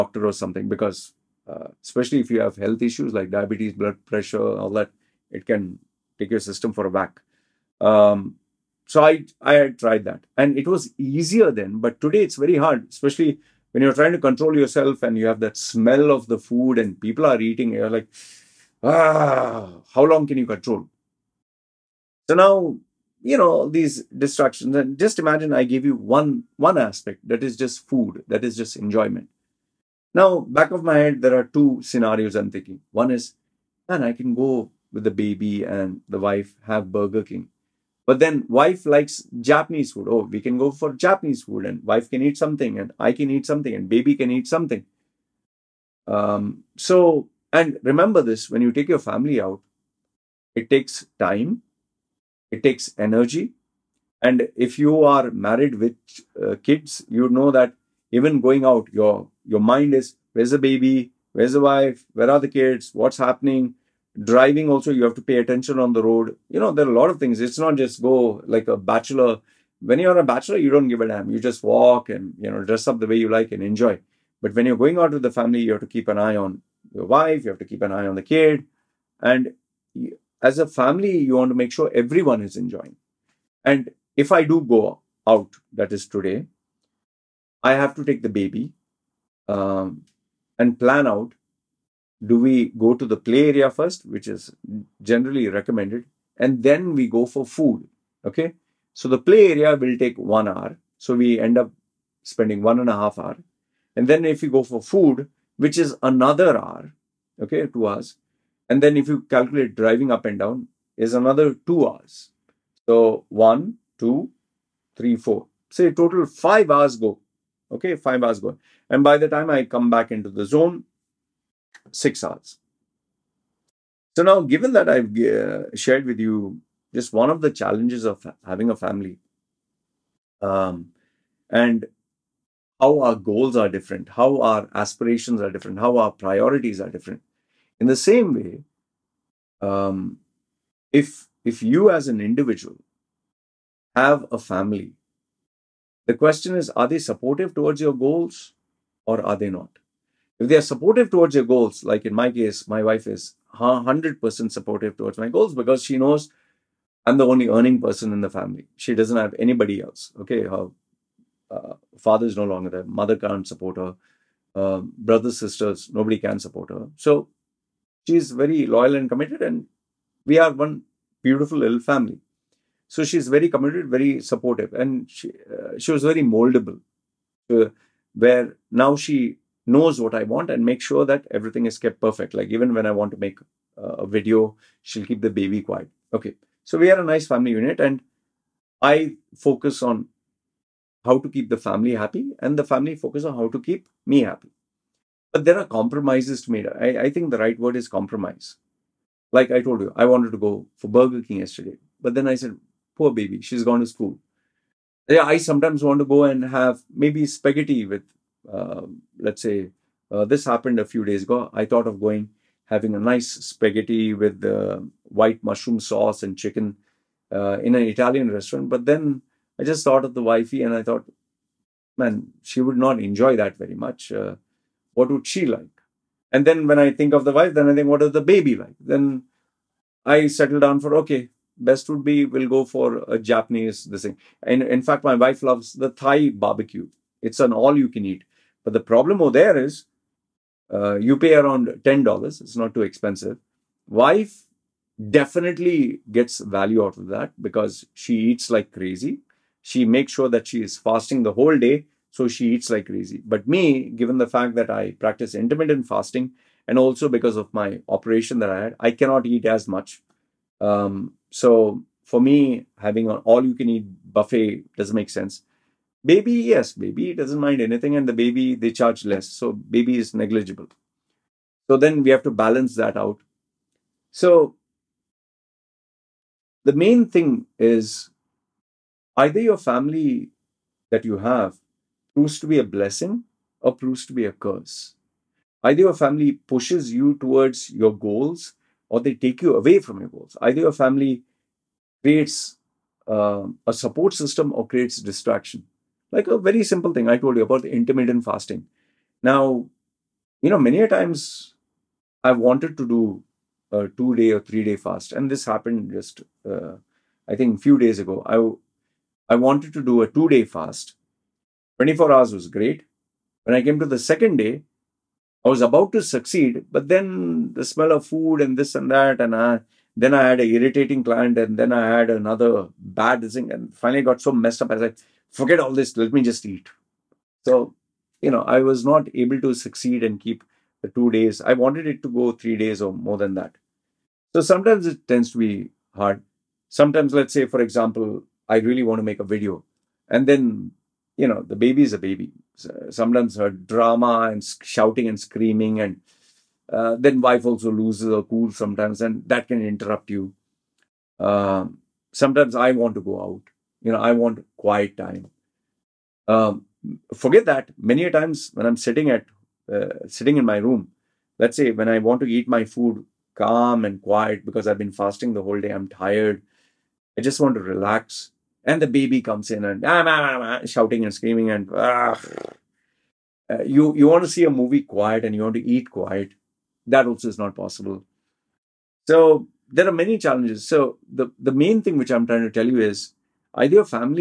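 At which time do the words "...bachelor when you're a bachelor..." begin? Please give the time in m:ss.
1:08.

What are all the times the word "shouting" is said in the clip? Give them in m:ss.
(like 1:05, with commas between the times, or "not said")
5:44, 6:10.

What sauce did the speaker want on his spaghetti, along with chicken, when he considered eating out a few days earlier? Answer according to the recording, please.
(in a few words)
white mushroom sauce.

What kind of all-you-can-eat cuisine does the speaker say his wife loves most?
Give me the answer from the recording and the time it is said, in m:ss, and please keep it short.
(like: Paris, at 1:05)
Thai barbecue, at 3:55.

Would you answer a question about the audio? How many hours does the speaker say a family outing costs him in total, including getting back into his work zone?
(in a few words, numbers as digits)
6 hours.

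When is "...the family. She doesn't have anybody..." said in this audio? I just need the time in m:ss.
2:38.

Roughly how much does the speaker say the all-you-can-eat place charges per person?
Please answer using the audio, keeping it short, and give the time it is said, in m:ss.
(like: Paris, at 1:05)
$10, at 4:01.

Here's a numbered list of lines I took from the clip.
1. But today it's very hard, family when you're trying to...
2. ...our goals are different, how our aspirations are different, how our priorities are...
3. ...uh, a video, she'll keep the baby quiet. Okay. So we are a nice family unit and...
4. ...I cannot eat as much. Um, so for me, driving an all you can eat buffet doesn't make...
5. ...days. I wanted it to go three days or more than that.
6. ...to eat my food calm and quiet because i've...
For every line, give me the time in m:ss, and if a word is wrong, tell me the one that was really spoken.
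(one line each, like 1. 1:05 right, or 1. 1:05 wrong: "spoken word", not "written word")
1. 0:11 wrong: "especially", not "family"
2. 2:12 right
3. 3:03 right
4. 4:18 wrong: "having", not "driving"
5. 5:31 right
6. 6:02 right.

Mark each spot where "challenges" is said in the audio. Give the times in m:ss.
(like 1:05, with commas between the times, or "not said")
2:07, 6:20.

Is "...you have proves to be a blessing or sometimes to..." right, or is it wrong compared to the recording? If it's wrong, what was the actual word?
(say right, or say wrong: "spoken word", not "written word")
wrong: "proves", not "sometimes".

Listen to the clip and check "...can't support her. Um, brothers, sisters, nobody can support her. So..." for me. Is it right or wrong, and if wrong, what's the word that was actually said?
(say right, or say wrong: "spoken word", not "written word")
right.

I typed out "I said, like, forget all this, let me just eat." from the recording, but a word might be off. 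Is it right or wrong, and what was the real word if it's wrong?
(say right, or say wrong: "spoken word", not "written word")
right.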